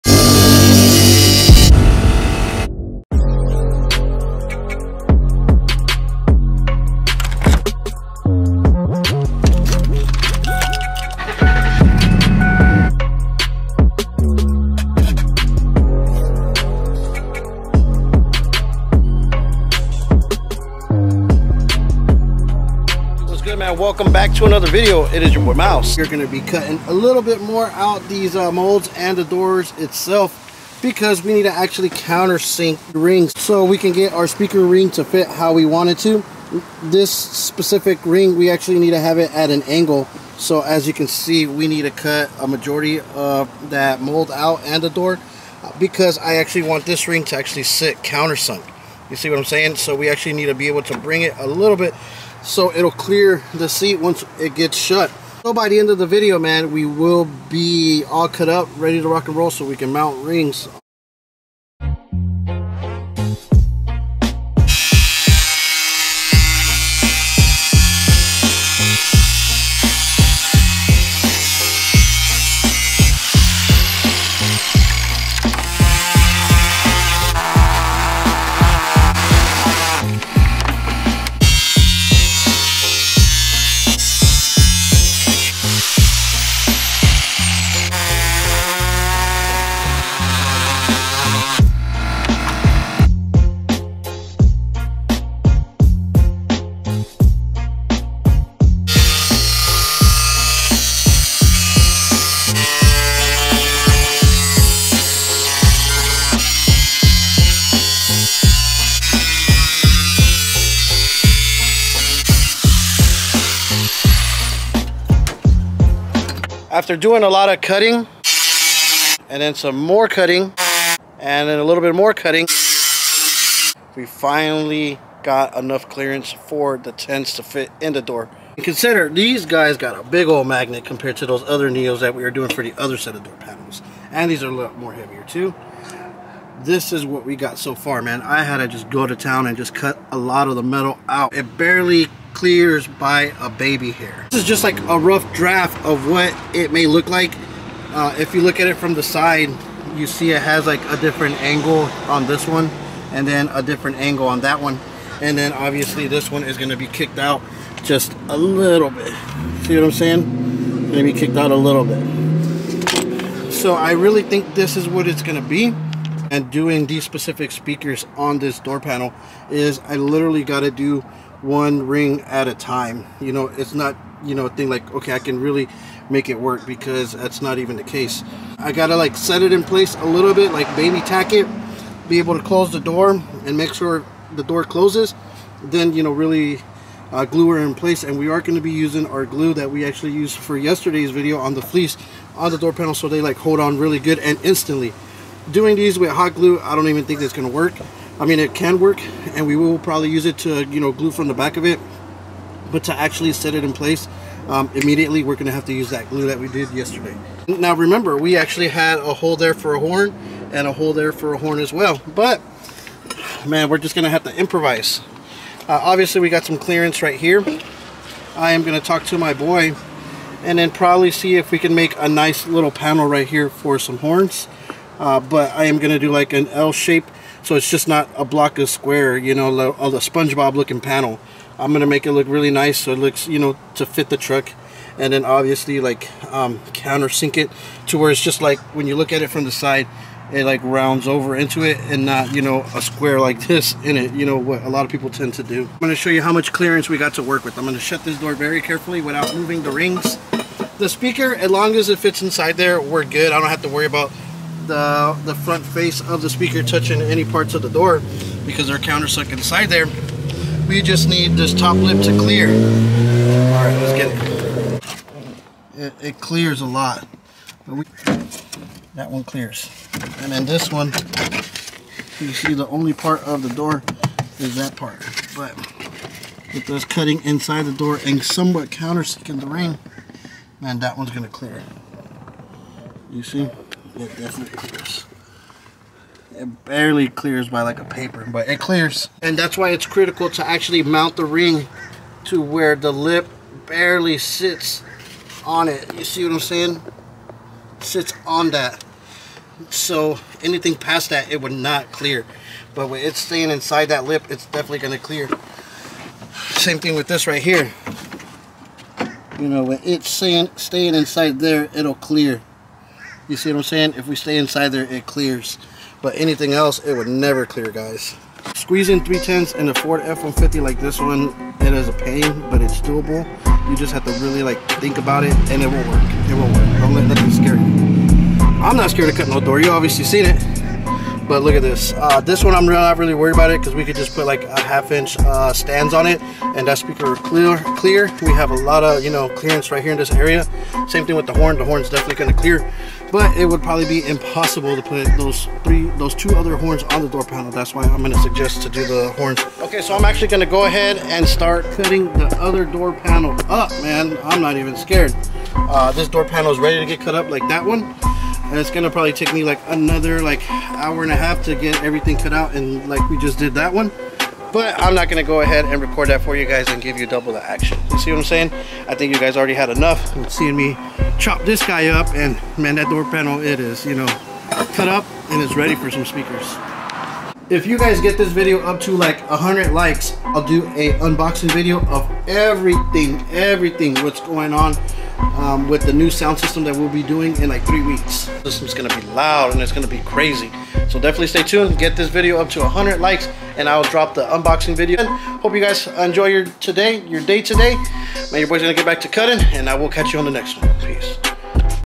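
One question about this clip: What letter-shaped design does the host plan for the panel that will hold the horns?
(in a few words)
L shape.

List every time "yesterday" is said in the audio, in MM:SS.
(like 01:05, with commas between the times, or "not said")
03:10, 03:26.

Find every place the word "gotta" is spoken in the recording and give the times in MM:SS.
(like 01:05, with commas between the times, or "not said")
02:58.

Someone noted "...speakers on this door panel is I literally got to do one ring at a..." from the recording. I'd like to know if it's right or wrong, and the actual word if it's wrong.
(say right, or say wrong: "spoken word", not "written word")
right.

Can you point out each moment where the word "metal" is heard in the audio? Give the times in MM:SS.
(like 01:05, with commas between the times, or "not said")
02:20.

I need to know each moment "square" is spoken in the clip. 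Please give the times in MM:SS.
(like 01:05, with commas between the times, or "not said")
03:48, 04:02.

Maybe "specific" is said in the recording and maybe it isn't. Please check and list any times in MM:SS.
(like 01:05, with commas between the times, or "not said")
00:37, 02:47.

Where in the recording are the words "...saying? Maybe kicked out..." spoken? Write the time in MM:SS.
02:39.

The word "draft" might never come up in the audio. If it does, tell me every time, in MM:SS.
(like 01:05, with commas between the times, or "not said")
02:25.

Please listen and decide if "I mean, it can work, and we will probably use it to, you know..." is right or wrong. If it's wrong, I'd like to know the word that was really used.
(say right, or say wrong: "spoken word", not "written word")
right.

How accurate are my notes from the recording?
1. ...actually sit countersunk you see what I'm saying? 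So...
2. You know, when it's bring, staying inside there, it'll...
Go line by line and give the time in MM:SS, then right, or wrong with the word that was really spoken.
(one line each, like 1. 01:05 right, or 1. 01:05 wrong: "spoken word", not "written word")
1. 00:47 right
2. 05:09 wrong: "staying", not "bring".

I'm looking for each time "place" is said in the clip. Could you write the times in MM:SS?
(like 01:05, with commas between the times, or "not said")
02:59, 03:07, 03:23.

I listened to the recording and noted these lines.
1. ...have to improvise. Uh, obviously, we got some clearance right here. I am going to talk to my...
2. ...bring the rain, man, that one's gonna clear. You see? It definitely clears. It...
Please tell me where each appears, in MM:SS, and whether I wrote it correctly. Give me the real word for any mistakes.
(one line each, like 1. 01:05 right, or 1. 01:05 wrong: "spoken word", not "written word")
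1. 03:34 right
2. 04:38 wrong: "countersinking", not "bring".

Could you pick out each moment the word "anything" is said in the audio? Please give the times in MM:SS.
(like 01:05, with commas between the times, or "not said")
05:00, 05:16.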